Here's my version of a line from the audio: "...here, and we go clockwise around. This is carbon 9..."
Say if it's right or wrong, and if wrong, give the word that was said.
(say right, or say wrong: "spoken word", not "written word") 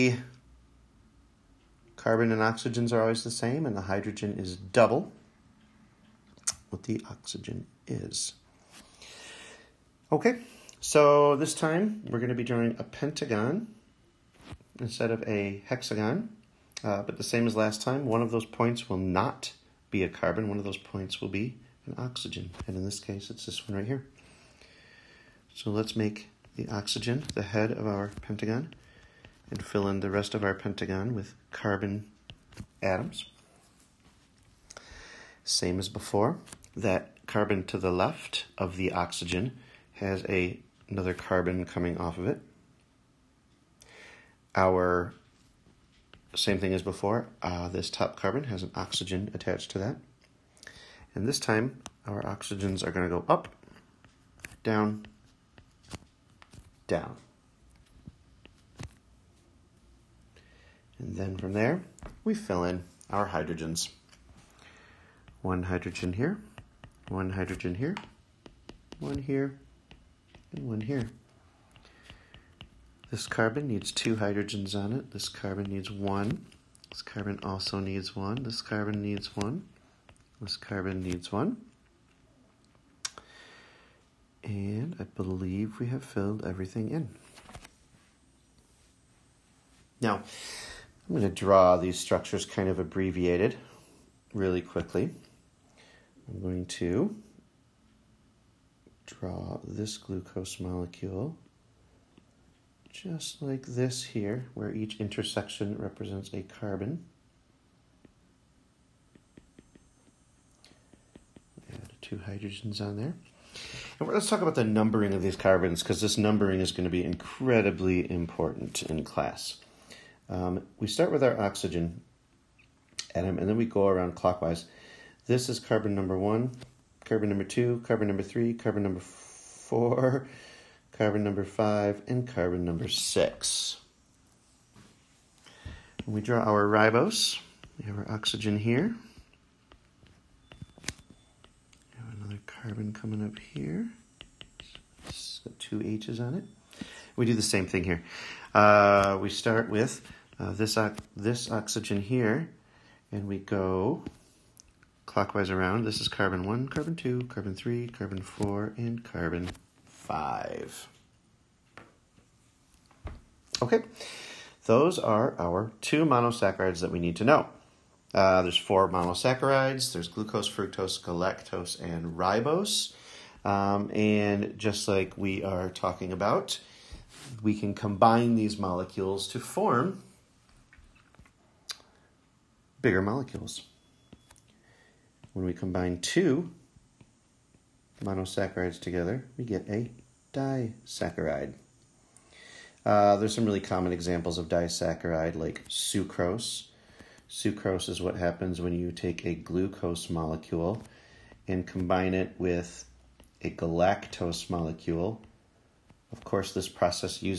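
wrong: "1", not "9".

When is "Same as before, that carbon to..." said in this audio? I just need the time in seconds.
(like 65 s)
35 s.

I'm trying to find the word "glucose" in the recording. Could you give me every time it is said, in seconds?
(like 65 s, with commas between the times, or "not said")
99 s, 170 s, 199 s.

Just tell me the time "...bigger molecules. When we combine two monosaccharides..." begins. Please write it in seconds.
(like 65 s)
182 s.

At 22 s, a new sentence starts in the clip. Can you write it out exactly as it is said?
And in this case, it's this one right here.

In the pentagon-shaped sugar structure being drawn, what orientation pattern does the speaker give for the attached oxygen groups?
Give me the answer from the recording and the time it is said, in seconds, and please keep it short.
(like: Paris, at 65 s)
up, down, down, at 53 s.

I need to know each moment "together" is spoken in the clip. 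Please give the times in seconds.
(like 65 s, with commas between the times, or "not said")
188 s.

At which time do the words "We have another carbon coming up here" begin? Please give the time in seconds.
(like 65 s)
141 s.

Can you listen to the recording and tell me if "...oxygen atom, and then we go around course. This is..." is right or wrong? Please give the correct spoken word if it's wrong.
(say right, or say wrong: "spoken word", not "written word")
wrong: "clockwise", not "course".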